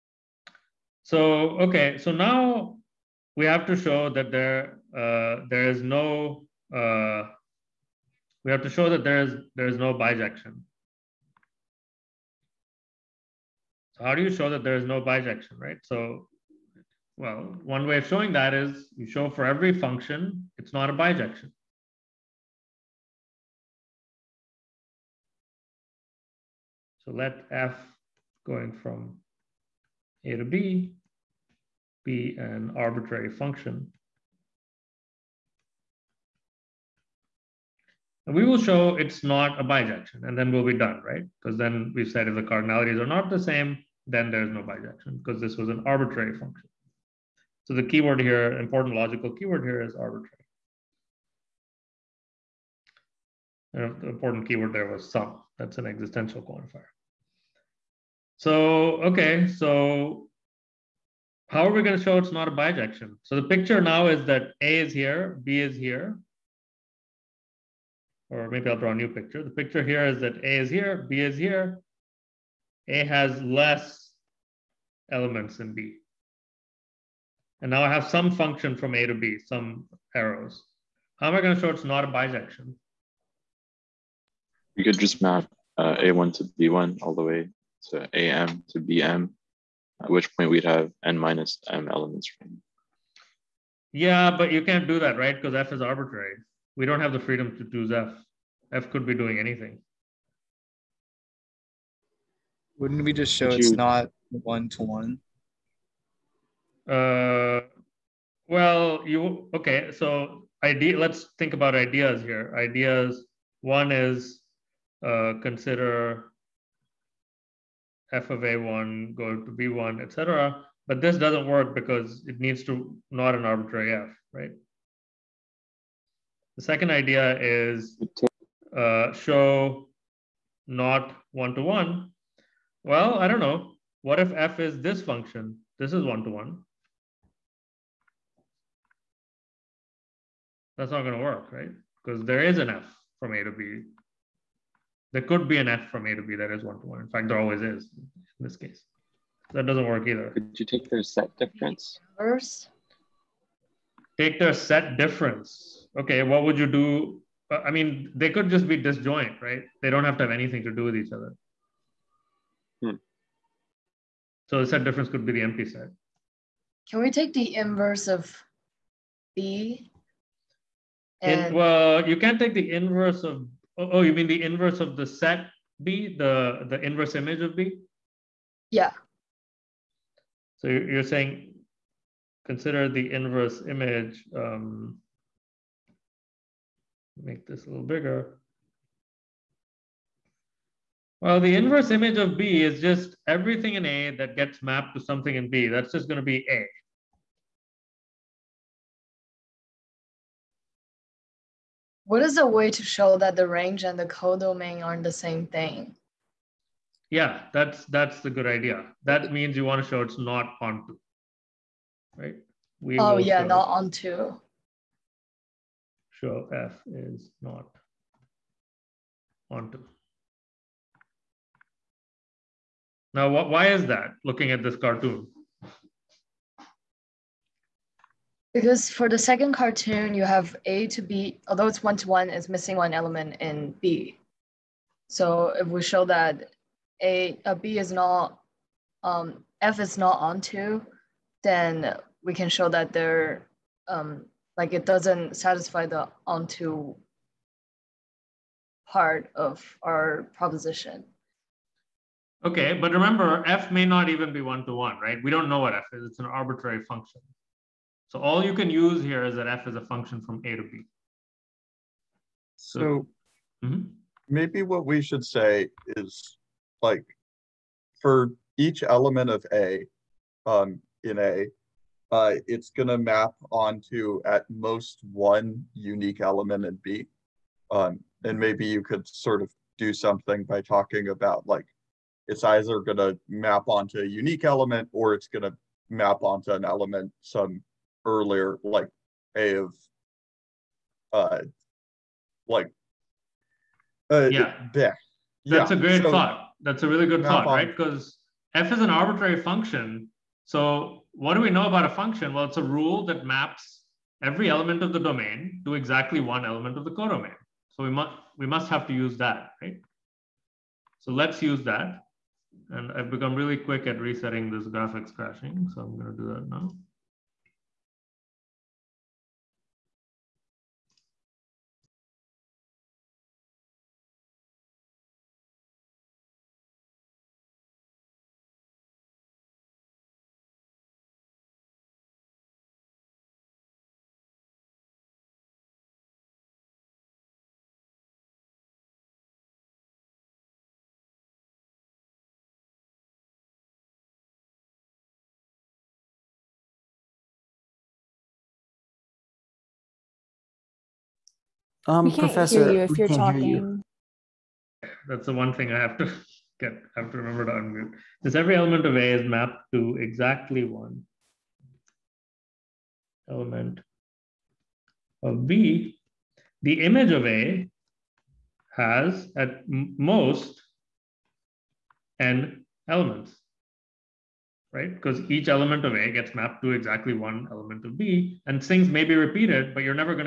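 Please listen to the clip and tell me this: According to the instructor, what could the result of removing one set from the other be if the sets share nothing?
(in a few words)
the empty set.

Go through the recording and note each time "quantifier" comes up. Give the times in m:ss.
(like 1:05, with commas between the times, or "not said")
0:56.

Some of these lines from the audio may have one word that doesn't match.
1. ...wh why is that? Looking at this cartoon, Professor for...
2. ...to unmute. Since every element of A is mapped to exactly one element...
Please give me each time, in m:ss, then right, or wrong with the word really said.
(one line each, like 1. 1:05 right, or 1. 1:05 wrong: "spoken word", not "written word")
1. 3:43 wrong: "Because", not "Professor"
2. 5:57 right.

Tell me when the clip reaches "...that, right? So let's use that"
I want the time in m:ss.
5:09.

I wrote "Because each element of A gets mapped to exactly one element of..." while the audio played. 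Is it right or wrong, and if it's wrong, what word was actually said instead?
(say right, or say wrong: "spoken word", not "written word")
right.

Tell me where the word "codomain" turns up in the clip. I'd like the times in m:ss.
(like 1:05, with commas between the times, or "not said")
3:24, 5:06.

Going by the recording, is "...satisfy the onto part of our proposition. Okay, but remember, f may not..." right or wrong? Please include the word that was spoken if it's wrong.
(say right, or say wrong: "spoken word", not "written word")
right.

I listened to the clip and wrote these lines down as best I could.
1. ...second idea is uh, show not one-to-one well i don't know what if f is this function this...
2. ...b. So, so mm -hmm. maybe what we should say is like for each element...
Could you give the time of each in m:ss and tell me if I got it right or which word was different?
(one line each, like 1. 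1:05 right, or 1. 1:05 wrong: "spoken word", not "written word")
1. 2:06 right
2. 4:20 right.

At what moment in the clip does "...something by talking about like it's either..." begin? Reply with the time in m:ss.
4:40.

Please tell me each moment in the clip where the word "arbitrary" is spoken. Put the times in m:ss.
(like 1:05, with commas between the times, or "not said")
0:32, 0:45, 0:49, 1:35, 2:03, 4:16, 4:58.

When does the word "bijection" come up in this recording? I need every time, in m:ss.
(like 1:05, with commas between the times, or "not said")
0:09, 0:15, 0:20, 0:39, 0:44, 1:02, 1:22.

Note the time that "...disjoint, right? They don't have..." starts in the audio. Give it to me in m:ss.
2:38.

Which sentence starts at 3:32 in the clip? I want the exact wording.
We oh yeah, show, not onto.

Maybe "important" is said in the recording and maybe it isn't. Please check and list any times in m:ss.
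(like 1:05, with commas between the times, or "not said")
0:48, 0:54.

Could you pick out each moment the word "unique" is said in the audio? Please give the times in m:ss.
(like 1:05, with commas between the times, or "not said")
4:35, 4:44.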